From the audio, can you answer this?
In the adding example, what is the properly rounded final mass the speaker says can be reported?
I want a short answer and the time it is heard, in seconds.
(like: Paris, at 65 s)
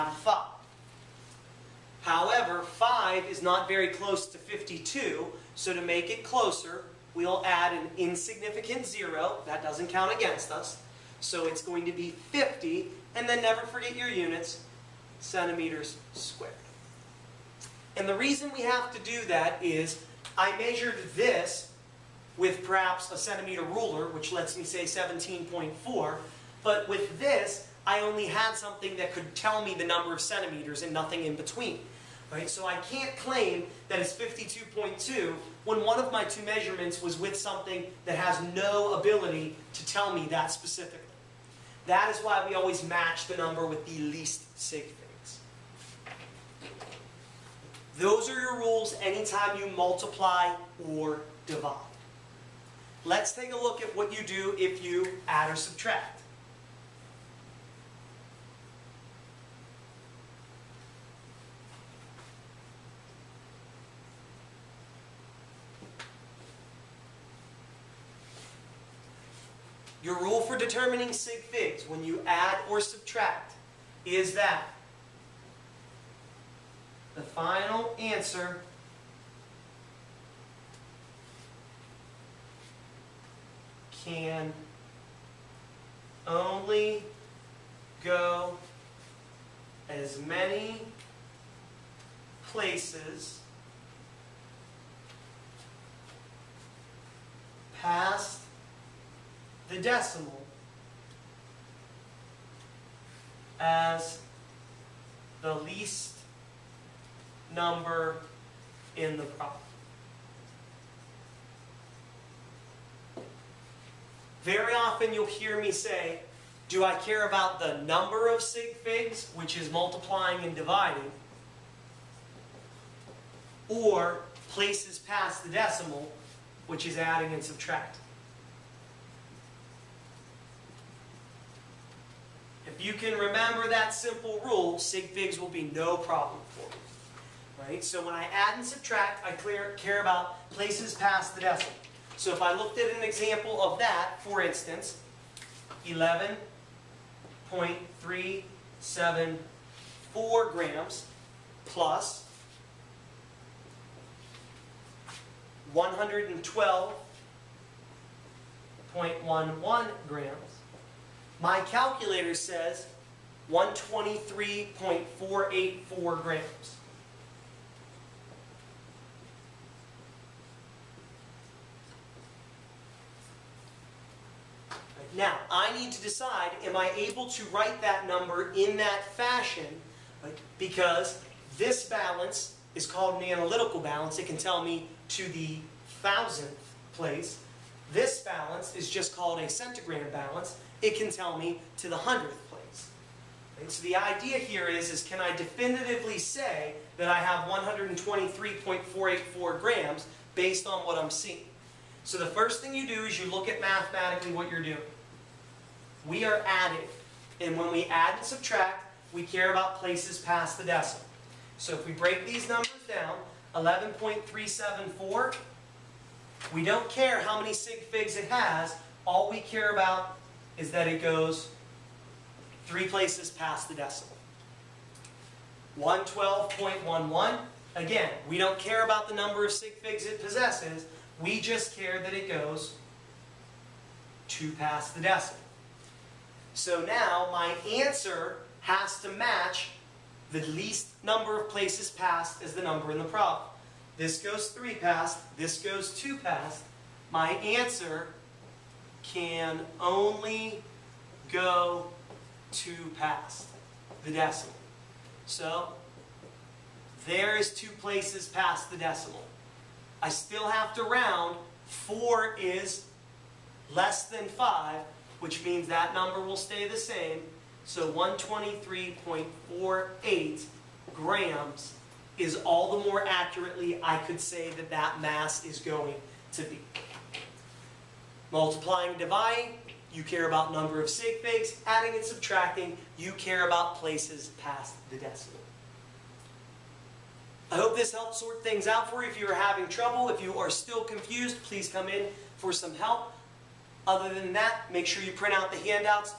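123.48 grams, at 267 s.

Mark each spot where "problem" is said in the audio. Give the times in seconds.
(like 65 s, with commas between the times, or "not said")
109 s, 135 s, 243 s.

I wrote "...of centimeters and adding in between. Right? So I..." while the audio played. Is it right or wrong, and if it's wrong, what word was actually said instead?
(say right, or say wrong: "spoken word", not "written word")
wrong: "nothing", not "adding".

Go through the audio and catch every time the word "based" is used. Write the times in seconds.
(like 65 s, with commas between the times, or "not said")
200 s.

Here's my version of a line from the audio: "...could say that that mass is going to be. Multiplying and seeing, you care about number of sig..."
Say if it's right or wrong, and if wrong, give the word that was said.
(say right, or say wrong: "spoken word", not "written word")
wrong: "dividing", not "seeing".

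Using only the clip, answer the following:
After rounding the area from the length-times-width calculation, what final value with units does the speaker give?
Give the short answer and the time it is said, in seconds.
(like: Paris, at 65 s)
50 cm², at 12 s.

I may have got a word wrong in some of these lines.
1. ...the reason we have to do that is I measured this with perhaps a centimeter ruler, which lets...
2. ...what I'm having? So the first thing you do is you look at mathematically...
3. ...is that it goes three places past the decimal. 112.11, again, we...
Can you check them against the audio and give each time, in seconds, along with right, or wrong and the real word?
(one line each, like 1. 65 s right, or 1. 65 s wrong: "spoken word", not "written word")
1. 18 s right
2. 200 s wrong: "seeing", not "having"
3. 220 s right.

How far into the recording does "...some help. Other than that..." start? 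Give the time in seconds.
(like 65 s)
292 s.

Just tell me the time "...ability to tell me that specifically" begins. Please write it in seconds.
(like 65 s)
39 s.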